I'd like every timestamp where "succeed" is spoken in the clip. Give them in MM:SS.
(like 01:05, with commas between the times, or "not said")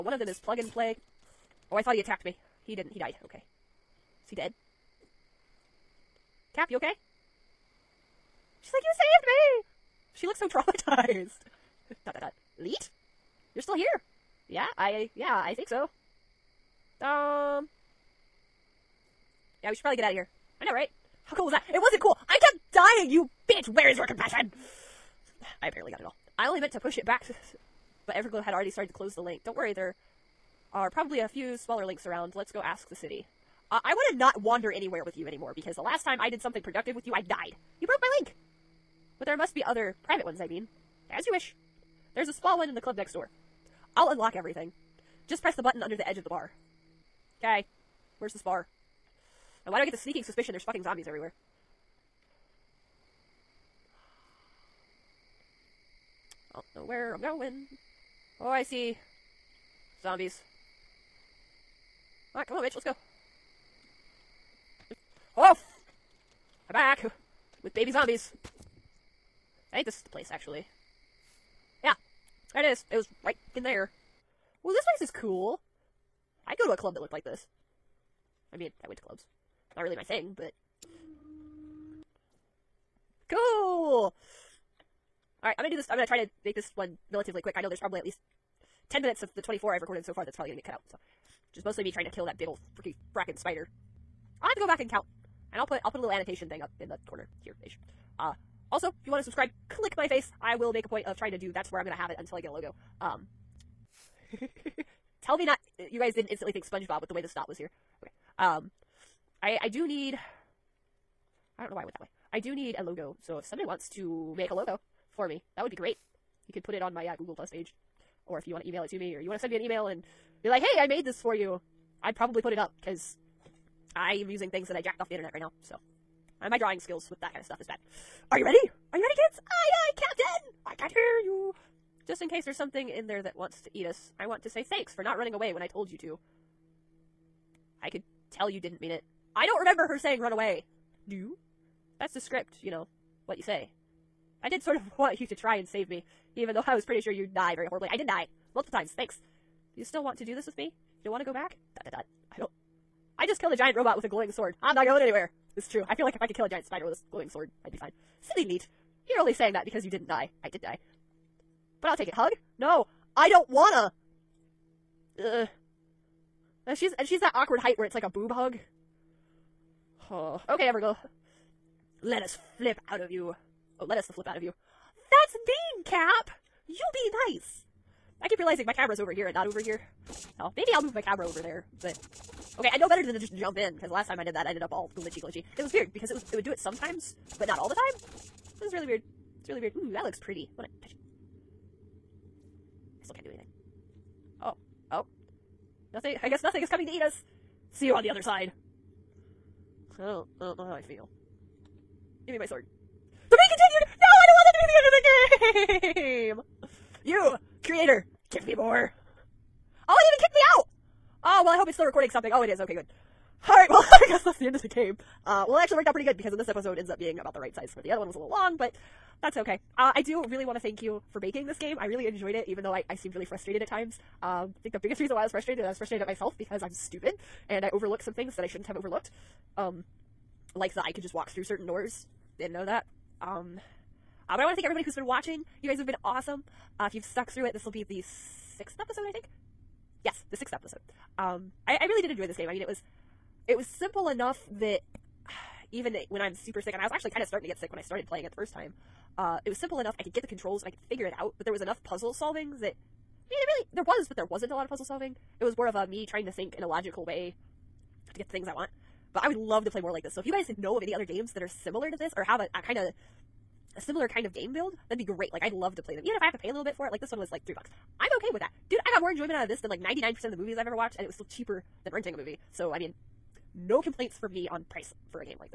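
not said.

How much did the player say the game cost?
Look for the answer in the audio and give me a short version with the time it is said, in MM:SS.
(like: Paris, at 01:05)
3 bucks, at 04:27.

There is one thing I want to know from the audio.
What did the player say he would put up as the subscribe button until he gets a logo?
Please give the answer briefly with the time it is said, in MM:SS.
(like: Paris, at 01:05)
my face, at 01:39.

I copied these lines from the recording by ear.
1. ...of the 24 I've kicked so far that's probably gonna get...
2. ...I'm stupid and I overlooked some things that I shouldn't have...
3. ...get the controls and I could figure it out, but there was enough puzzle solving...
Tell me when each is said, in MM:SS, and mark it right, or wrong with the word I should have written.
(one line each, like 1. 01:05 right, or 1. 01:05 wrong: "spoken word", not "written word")
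1. 01:29 wrong: "recorded", not "kicked"
2. 03:46 right
3. 04:10 right.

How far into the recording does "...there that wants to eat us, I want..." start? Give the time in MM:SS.
02:13.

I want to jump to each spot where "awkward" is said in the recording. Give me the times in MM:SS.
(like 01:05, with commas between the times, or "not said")
02:47.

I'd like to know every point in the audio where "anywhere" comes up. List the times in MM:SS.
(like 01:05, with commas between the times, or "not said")
00:34, 02:35.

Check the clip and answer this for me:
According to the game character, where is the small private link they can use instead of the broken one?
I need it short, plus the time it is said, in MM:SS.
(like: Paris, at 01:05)
the club next door, at 00:42.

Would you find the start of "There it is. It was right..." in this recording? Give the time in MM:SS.
01:12.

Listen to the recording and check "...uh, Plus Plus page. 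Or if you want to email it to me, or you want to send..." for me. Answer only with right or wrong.
wrong.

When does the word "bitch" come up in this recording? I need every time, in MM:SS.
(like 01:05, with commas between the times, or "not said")
00:23, 01:02.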